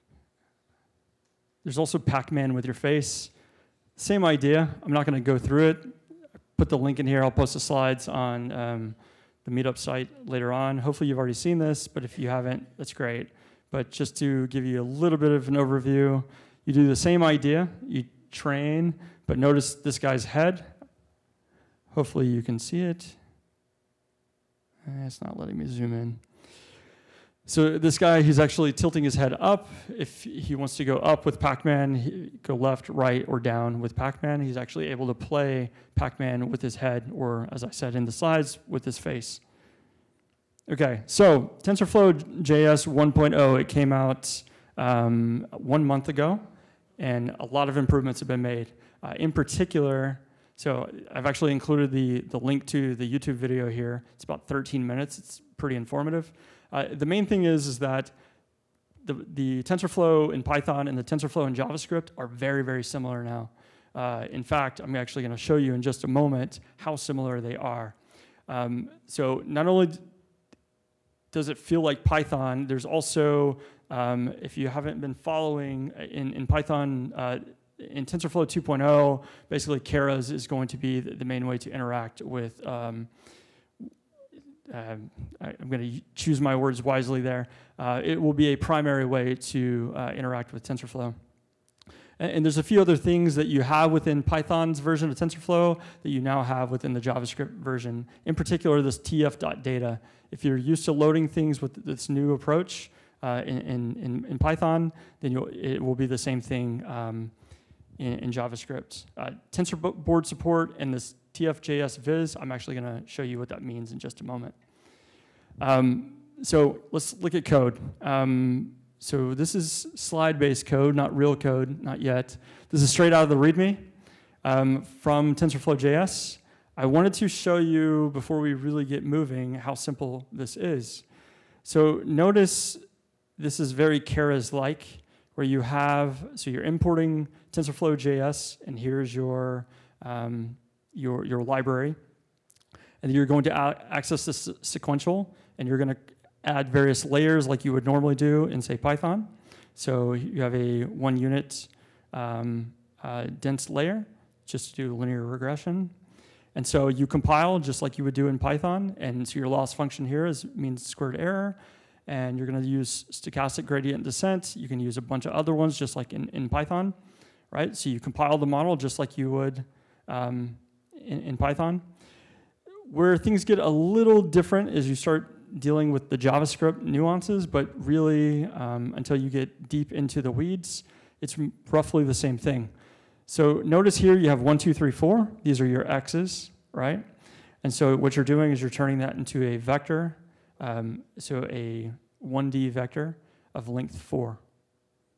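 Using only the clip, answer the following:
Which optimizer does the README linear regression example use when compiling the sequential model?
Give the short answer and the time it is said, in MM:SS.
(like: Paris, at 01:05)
Stochastic gradient descent, at 02:43.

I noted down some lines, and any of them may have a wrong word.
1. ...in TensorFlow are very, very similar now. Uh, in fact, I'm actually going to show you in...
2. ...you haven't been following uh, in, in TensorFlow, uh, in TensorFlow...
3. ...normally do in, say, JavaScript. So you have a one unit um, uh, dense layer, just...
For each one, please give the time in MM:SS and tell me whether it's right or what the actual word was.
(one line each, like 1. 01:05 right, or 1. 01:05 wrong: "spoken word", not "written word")
1. 01:01 wrong: "JavaScript", not "TensorFlow"
2. 01:14 wrong: "Python", not "TensorFlow"
3. 02:27 wrong: "Python", not "JavaScript".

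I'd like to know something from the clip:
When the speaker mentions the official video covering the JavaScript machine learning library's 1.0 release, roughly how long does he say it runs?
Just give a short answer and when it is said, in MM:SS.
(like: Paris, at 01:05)
13 minutes, at 00:54.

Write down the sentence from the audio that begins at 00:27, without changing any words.
So this guy, he's actually tilting his head up.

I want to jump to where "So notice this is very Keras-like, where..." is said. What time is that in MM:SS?
02:11.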